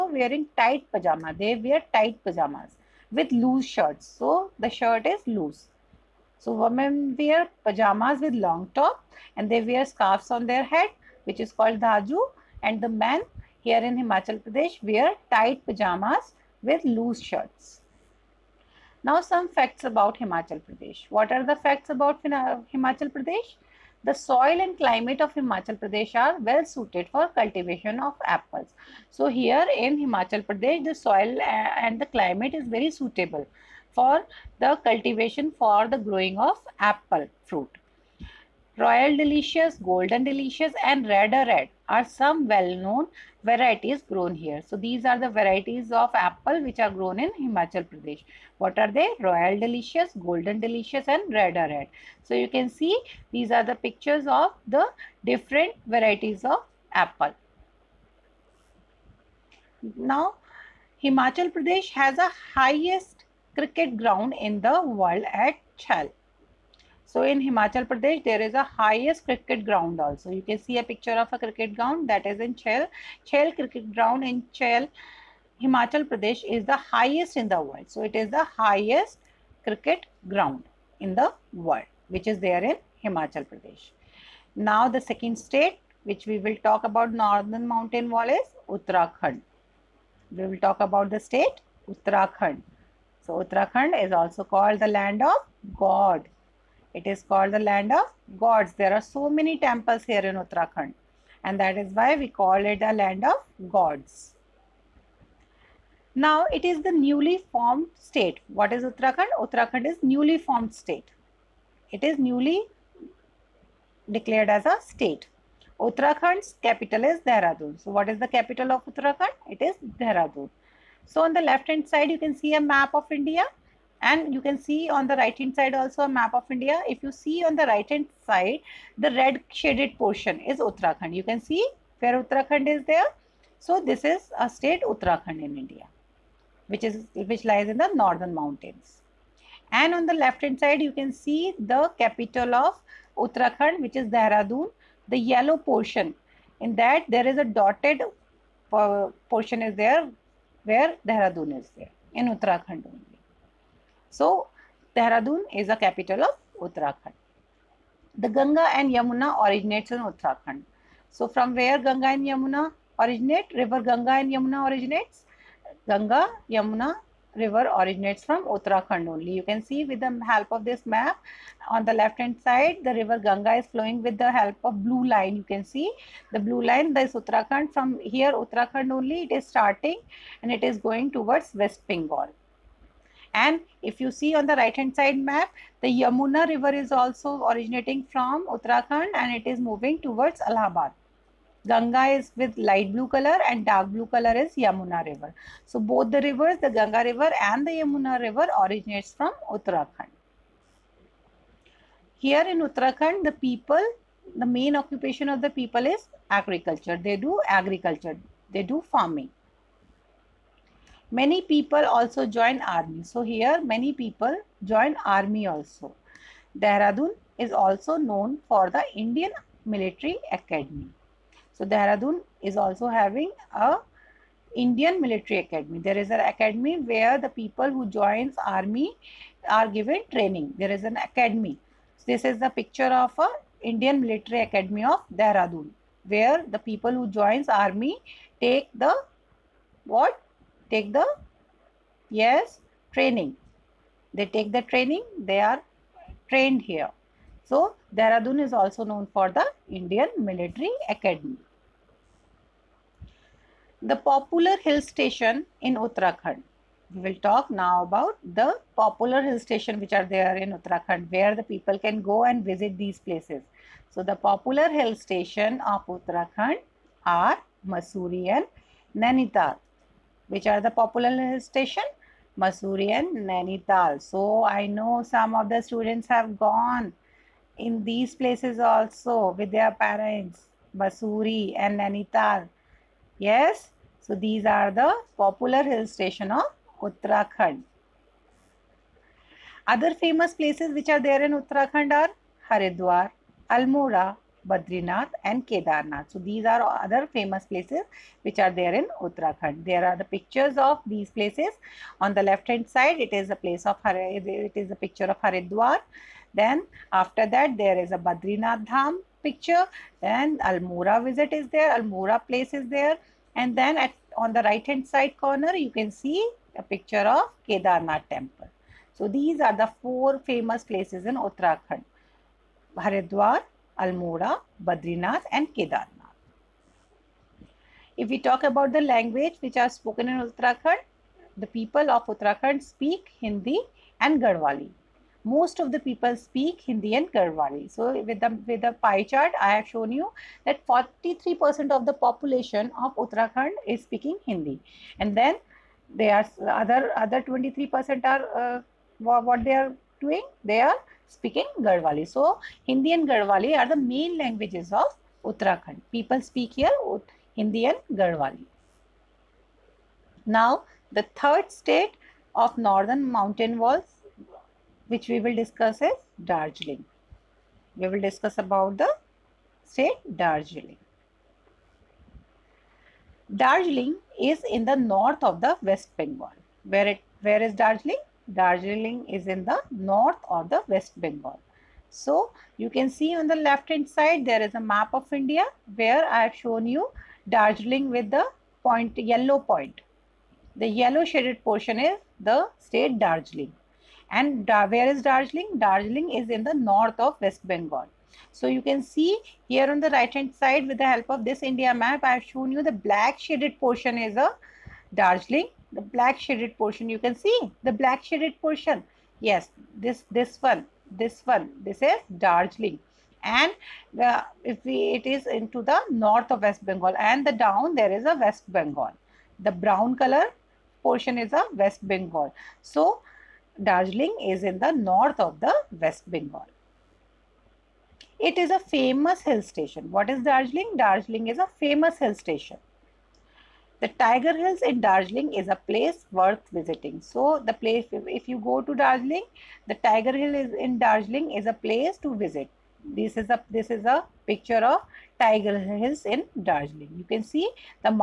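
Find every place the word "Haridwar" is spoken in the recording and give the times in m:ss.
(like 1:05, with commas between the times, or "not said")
4:52, 5:05, 5:22.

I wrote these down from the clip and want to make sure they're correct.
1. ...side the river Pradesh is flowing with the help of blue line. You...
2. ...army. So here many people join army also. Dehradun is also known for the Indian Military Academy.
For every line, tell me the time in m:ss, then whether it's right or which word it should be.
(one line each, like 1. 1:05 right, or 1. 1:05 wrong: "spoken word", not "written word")
1. 2:52 wrong: "Ganga", not "Pradesh"
2. 3:32 right.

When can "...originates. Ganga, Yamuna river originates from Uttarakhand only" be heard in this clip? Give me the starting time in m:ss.
2:44.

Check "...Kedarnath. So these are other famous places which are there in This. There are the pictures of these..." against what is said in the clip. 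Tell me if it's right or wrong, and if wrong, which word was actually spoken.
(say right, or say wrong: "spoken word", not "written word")
wrong: "Uttarakhand", not "This".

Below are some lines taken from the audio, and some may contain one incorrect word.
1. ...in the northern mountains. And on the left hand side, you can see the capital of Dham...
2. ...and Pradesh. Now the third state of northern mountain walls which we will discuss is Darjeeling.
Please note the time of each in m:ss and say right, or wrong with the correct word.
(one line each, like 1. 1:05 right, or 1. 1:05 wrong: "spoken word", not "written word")
1. 2:17 wrong: "Uttarakhand", not "Dham"
2. 5:57 wrong: "Garhwali", not "Pradesh".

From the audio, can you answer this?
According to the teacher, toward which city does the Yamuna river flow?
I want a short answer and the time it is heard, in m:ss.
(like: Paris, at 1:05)
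Allahabad, at 3:10.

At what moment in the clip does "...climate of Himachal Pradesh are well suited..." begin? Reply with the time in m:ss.
0:24.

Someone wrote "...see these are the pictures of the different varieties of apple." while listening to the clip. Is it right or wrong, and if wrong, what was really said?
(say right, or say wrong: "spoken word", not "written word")
right.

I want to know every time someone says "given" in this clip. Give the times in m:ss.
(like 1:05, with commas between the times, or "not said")
3:49.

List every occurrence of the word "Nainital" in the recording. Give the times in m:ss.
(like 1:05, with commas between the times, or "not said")
4:29, 4:33, 4:41.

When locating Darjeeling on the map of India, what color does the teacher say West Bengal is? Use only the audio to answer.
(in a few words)
Brown.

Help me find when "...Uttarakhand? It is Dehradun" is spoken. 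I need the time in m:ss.
1:58.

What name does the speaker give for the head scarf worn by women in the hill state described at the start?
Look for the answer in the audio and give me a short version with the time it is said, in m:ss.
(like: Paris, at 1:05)
Dhazu, at 0:11.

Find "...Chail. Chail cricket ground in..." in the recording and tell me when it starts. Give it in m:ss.
1:12.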